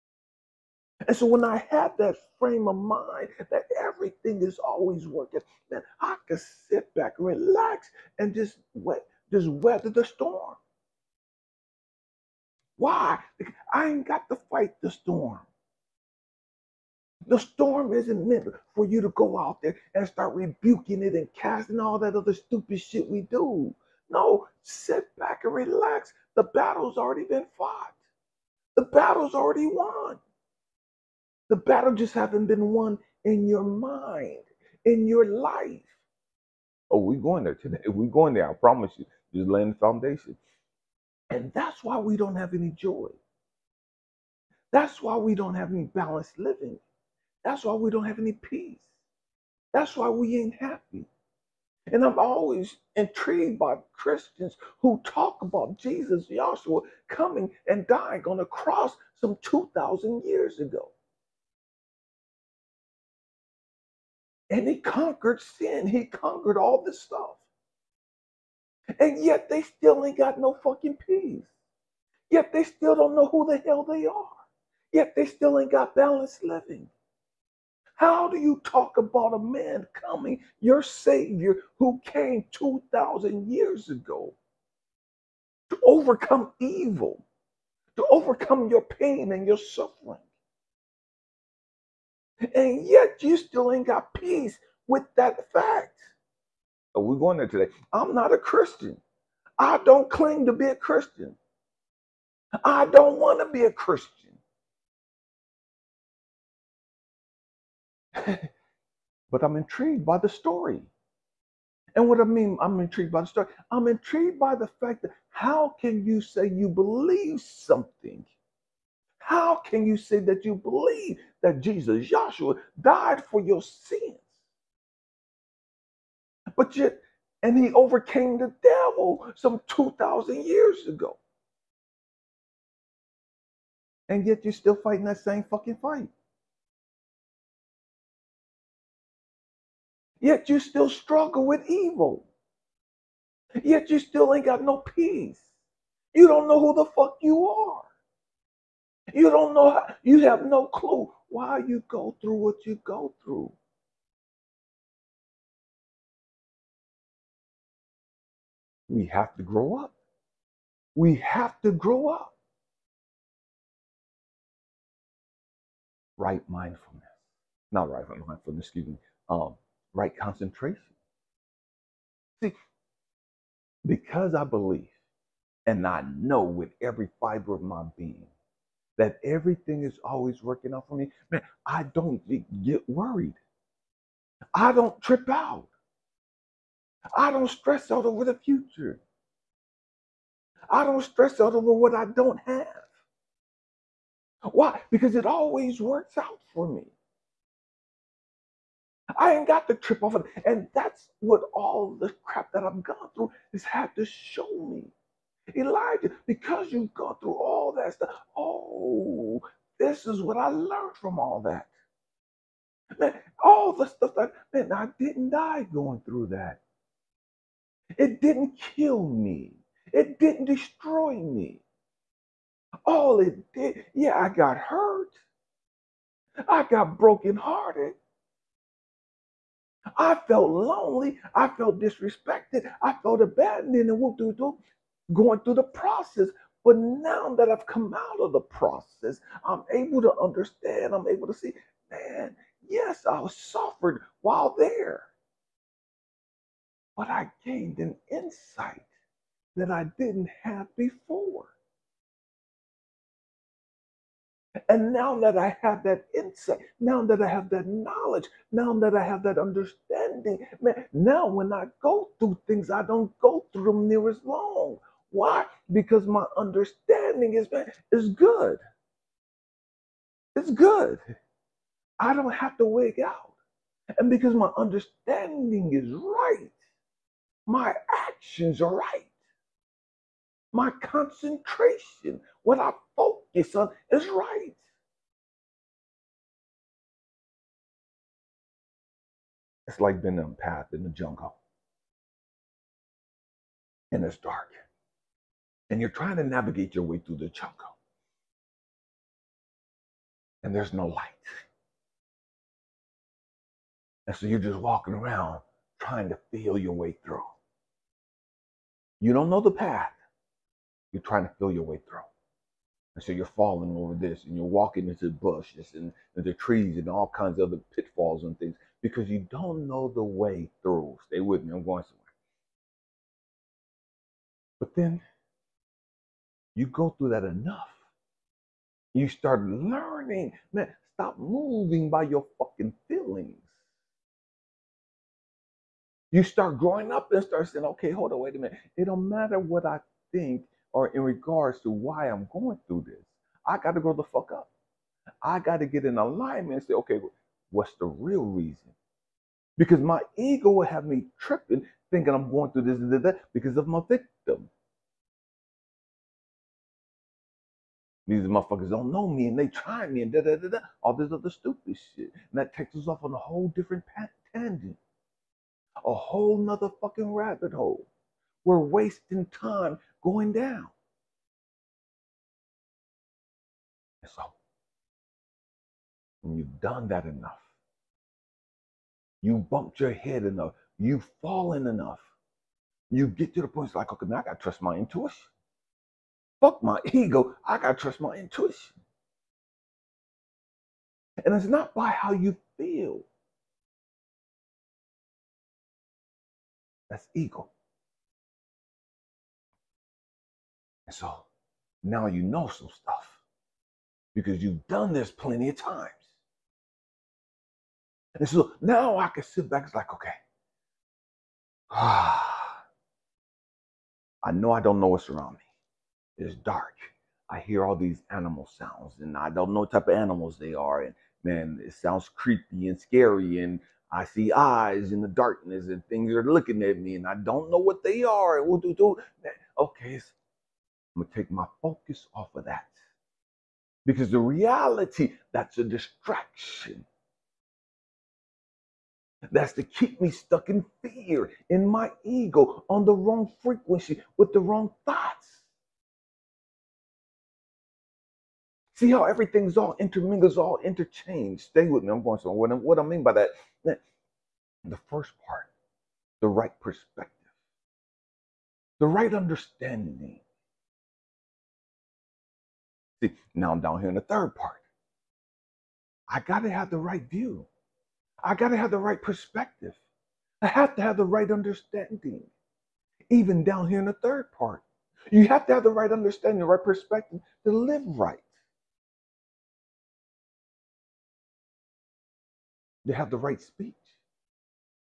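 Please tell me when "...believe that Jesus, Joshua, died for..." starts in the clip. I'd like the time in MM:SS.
02:00.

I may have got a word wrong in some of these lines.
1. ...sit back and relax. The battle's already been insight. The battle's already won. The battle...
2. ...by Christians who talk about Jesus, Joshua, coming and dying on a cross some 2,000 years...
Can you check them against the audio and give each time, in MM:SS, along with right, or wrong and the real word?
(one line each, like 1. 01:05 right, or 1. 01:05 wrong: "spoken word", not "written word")
1. 00:24 wrong: "fought", not "insight"
2. 00:53 right.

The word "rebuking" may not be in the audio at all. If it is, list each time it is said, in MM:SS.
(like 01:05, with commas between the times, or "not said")
00:20.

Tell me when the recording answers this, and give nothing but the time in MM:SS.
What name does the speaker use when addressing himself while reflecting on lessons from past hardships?
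03:25.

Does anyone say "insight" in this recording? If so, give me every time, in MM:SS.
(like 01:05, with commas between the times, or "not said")
04:08, 04:16.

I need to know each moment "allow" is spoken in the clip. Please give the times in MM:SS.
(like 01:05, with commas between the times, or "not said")
not said.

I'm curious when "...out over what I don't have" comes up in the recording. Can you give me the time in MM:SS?
03:11.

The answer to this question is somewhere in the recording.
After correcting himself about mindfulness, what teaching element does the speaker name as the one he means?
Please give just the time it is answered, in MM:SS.
02:49.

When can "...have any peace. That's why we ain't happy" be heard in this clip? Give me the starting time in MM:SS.
00:48.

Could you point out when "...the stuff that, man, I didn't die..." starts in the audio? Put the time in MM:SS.
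03:33.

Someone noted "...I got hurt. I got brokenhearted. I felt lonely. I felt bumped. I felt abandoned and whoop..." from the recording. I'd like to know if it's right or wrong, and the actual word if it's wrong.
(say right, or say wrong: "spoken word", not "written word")
wrong: "disrespected", not "bumped".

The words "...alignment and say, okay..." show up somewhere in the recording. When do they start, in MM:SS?
05:45.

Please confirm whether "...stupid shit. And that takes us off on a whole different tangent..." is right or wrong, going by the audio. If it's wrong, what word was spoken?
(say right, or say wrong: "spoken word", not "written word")
right.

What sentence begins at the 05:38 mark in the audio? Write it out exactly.
It don't matter what I think or in regards to why I'm going through this.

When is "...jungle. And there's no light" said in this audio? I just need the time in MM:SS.
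04:57.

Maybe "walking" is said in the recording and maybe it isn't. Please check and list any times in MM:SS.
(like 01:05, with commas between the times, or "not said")
05:04, 05:14.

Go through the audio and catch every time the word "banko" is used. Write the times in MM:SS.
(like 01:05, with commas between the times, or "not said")
not said.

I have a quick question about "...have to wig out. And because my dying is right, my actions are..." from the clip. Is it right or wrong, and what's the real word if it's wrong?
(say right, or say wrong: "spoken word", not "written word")
wrong: "understanding", not "dying".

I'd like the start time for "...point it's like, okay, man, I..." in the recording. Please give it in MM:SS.
06:23.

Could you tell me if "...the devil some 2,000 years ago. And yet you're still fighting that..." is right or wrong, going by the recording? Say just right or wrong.
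right.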